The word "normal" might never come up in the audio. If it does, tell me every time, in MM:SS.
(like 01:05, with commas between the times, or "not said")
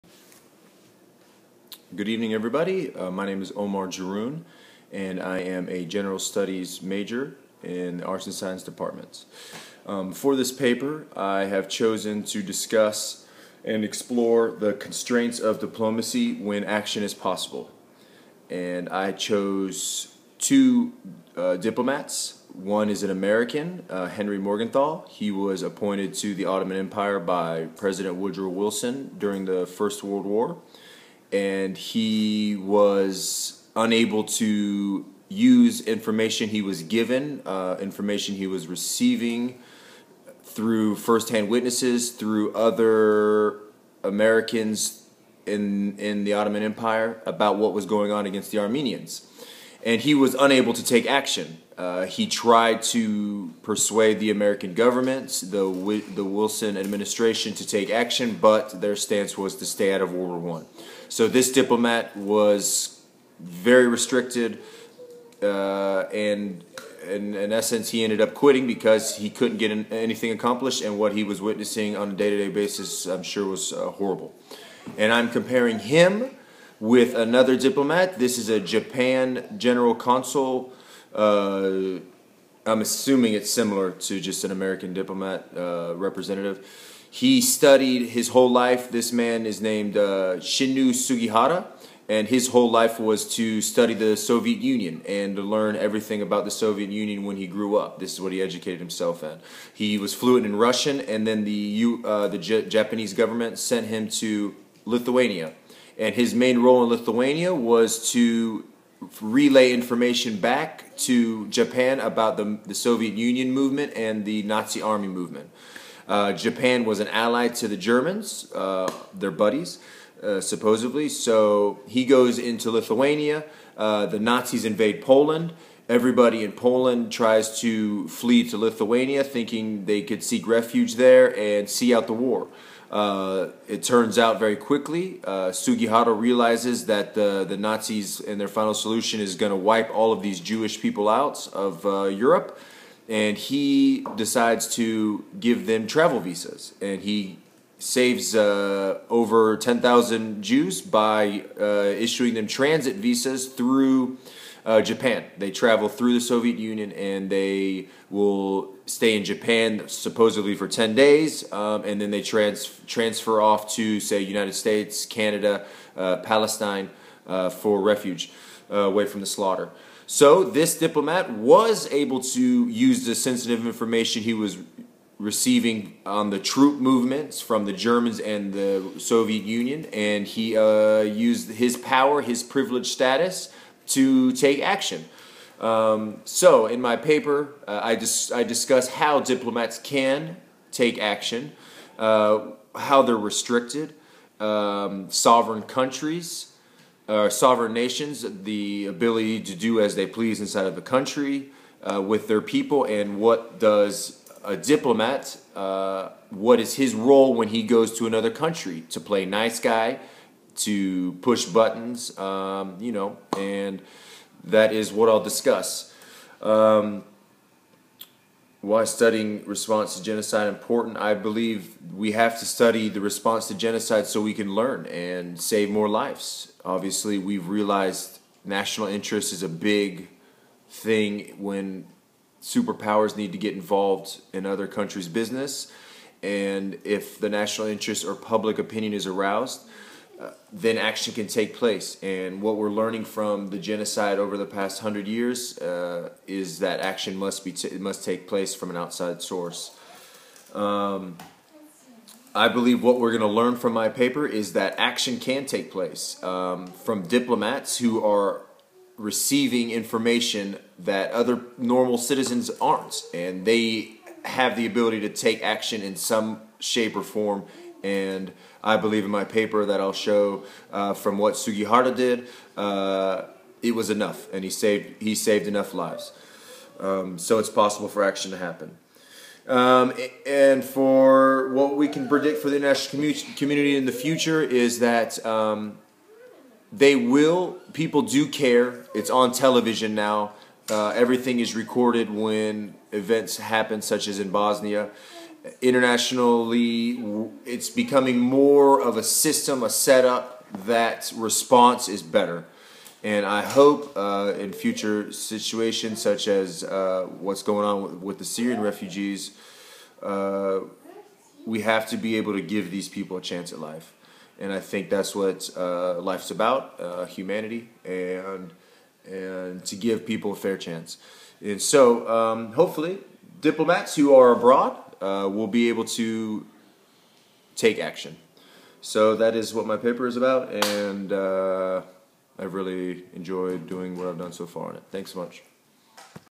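04:21.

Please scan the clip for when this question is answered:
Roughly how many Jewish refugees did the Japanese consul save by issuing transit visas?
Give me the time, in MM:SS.
02:29.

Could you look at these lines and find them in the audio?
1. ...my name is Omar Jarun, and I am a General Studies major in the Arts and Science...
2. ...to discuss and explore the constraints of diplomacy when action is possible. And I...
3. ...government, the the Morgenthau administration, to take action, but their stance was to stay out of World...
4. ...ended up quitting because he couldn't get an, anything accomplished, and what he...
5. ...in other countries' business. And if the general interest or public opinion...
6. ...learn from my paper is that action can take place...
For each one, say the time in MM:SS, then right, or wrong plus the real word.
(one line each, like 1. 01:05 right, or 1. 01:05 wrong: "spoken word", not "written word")
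1. 00:03 right
2. 00:12 right
3. 00:54 wrong: "Wilson", not "Morgenthau"
4. 01:08 right
5. 03:54 wrong: "national", not "general"
6. 04:13 right.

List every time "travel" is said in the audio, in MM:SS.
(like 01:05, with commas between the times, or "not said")
02:25, 02:35.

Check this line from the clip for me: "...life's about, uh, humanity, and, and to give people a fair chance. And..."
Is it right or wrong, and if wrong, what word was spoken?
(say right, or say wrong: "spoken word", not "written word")
right.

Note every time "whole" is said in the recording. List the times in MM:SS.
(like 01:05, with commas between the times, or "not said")
01:28, 01:32.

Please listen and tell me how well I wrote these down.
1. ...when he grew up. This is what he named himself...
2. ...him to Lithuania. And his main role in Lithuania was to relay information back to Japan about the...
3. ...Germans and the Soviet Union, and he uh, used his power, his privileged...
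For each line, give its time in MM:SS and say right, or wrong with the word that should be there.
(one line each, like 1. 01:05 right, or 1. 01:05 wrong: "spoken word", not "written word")
1. 01:37 wrong: "educated", not "named"
2. 01:43 right
3. 02:57 right.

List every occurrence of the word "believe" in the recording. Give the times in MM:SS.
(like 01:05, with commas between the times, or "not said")
03:41, 04:12, 04:28.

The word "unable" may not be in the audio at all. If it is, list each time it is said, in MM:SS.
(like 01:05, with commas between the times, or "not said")
00:33, 00:50.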